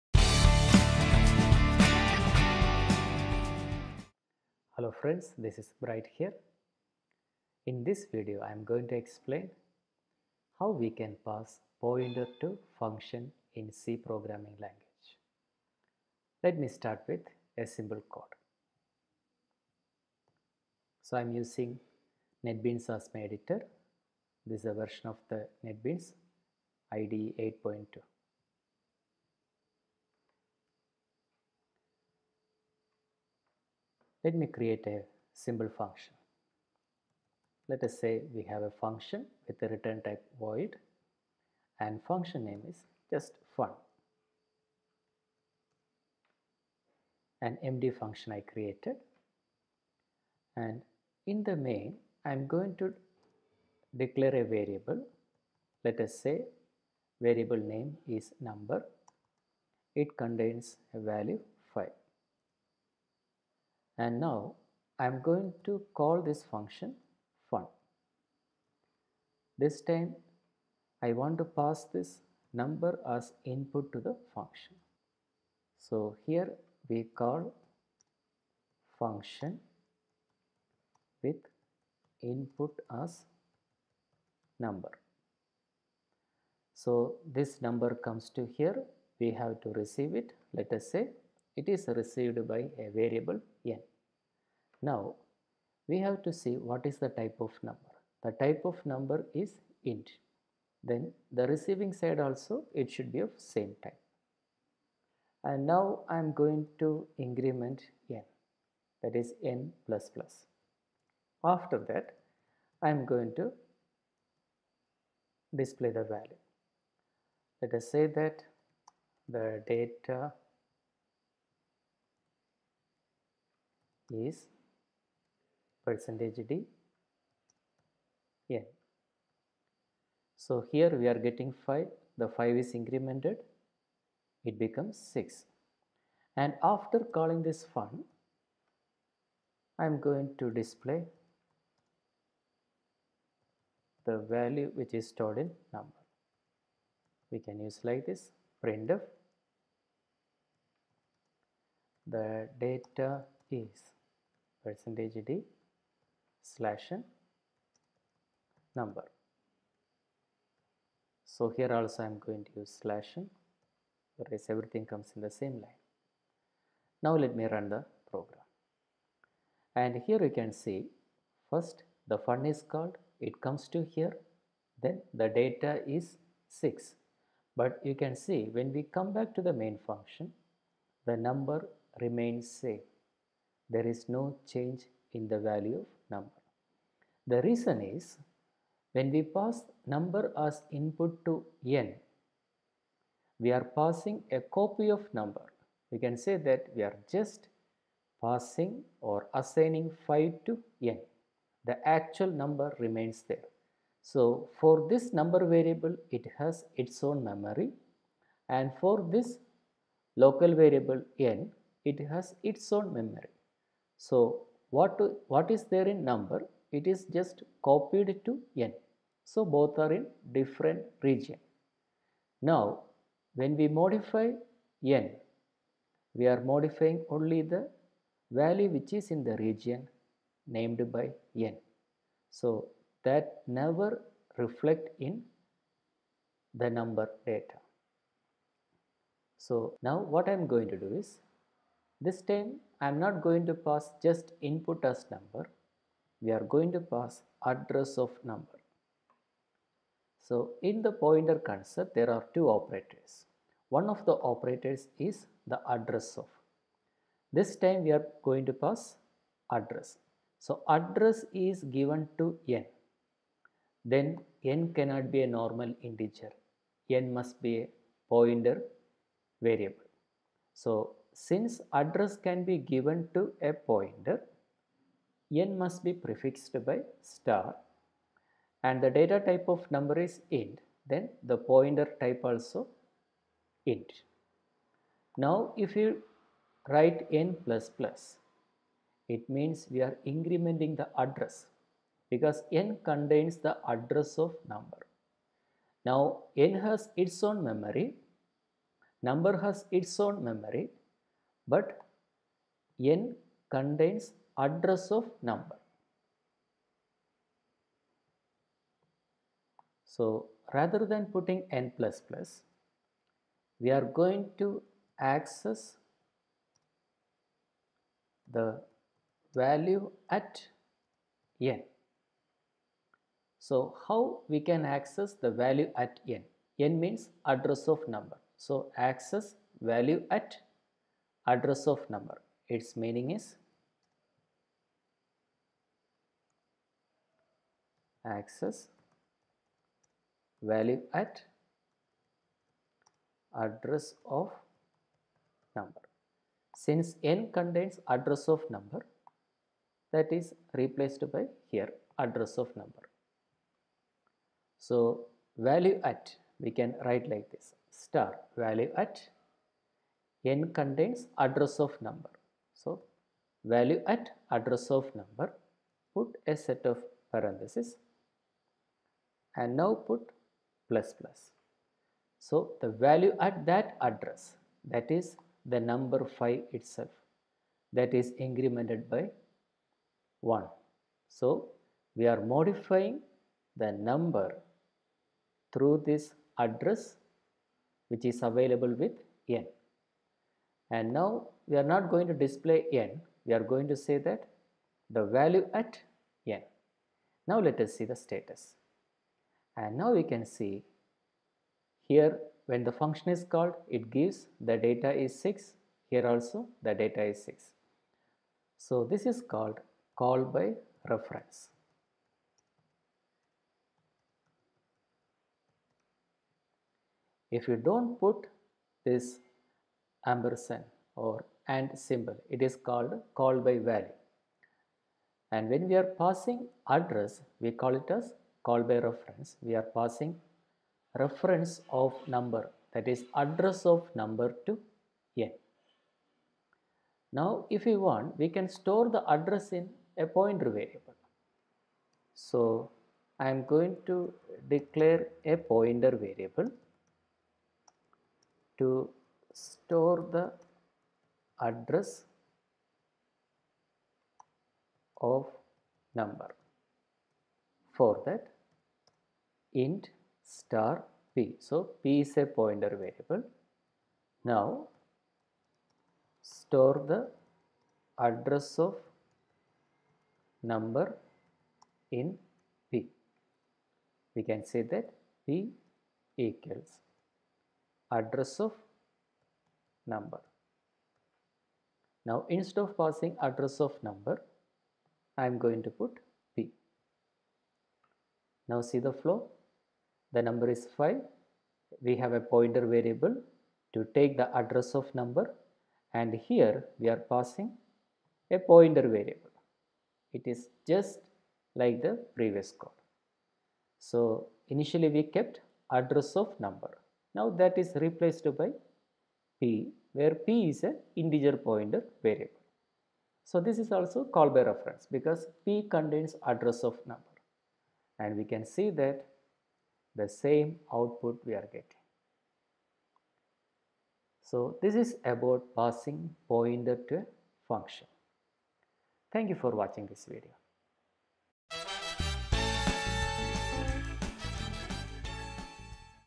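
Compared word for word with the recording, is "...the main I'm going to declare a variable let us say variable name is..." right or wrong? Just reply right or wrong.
right.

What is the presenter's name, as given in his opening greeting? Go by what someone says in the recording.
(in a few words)
Bright.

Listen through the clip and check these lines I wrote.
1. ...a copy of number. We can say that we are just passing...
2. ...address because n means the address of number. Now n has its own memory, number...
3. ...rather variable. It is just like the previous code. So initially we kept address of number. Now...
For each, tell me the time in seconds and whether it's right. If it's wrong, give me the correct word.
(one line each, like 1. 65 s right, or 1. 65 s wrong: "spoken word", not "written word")
1. 194 s right
2. 290 s wrong: "contains", not "means"
3. 498 s wrong: "pointer", not "rather".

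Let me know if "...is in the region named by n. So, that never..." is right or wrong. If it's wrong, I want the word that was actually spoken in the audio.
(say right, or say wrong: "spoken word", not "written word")
right.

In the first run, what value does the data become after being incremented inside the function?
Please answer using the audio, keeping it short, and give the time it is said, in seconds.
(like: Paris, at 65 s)
6, at 134 s.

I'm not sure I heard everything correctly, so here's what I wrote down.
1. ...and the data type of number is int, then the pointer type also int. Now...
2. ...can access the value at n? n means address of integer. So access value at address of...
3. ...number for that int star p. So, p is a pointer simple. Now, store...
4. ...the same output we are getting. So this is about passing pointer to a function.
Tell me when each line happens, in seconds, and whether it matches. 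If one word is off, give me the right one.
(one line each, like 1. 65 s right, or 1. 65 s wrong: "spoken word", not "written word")
1. 278 s right
2. 324 s wrong: "number", not "integer"
3. 455 s wrong: "variable", not "simple"
4. 520 s right.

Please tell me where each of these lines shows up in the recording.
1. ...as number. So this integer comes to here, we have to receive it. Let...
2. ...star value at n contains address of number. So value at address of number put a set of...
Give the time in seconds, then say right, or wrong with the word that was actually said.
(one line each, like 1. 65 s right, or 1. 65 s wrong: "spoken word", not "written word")
1. 83 s wrong: "number", not "integer"
2. 357 s right.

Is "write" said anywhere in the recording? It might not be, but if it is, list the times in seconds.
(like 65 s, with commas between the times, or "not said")
286 s, 356 s.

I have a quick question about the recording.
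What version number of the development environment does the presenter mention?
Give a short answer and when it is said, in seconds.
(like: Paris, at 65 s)
8.2, at 27 s.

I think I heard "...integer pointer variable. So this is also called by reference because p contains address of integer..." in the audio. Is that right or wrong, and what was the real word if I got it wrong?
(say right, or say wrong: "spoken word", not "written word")
wrong: "number", not "integer".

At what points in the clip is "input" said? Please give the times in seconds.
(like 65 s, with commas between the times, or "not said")
73 s, 82 s, 190 s, 244 s.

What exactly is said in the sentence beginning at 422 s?
It is called called by value.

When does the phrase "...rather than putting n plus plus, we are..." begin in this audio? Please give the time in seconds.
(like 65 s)
310 s.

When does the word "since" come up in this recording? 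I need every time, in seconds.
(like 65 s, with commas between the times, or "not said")
271 s, 346 s.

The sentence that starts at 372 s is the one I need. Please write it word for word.
So the value at that address that is the number 5 itself that is incremented by 1.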